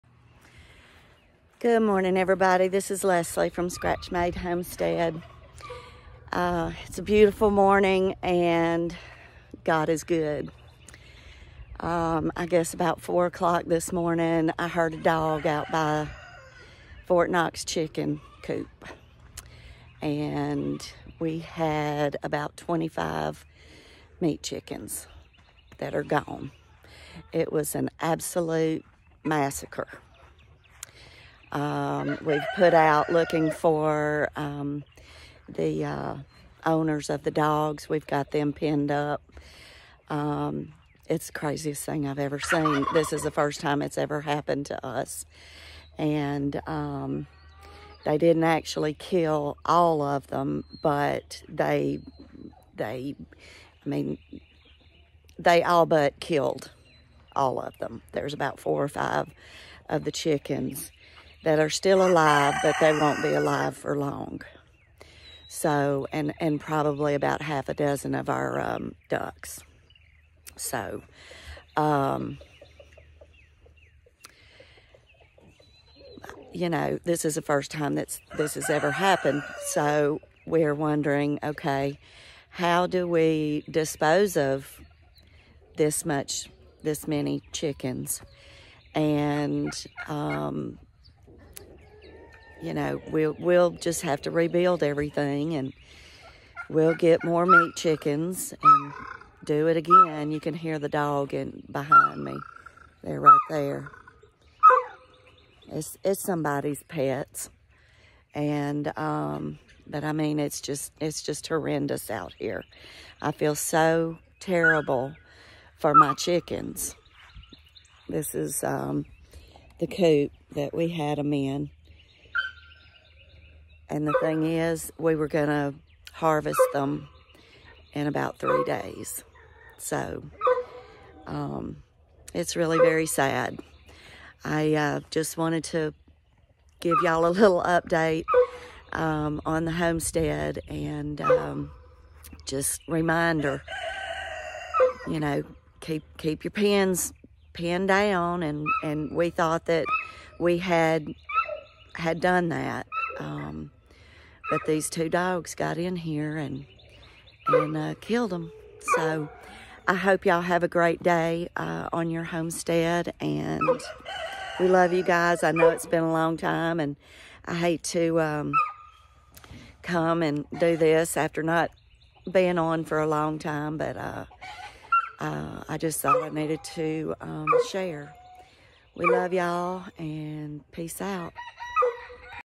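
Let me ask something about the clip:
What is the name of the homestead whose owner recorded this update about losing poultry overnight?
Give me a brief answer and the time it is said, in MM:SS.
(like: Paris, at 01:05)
Scratch Made Homestead, at 00:03.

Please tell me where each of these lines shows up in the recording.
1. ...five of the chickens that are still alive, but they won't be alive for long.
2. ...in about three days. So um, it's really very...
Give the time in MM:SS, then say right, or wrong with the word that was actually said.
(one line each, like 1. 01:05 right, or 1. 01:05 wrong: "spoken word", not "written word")
1. 00:58 right
2. 02:07 right.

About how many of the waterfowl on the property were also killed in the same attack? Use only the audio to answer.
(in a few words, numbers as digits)
half a dozen.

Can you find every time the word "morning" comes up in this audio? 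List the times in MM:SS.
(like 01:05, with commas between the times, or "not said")
00:01, 00:07, 00:13.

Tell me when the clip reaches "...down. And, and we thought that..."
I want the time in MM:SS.
02:27.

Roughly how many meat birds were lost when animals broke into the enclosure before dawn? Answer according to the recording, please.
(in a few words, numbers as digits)
25.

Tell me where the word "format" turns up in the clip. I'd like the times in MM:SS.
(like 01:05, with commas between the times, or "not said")
not said.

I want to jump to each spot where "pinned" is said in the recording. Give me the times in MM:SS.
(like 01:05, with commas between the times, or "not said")
00:38, 02:27.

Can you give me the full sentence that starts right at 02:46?
And I hate to um, come and do this after not being on for a long time.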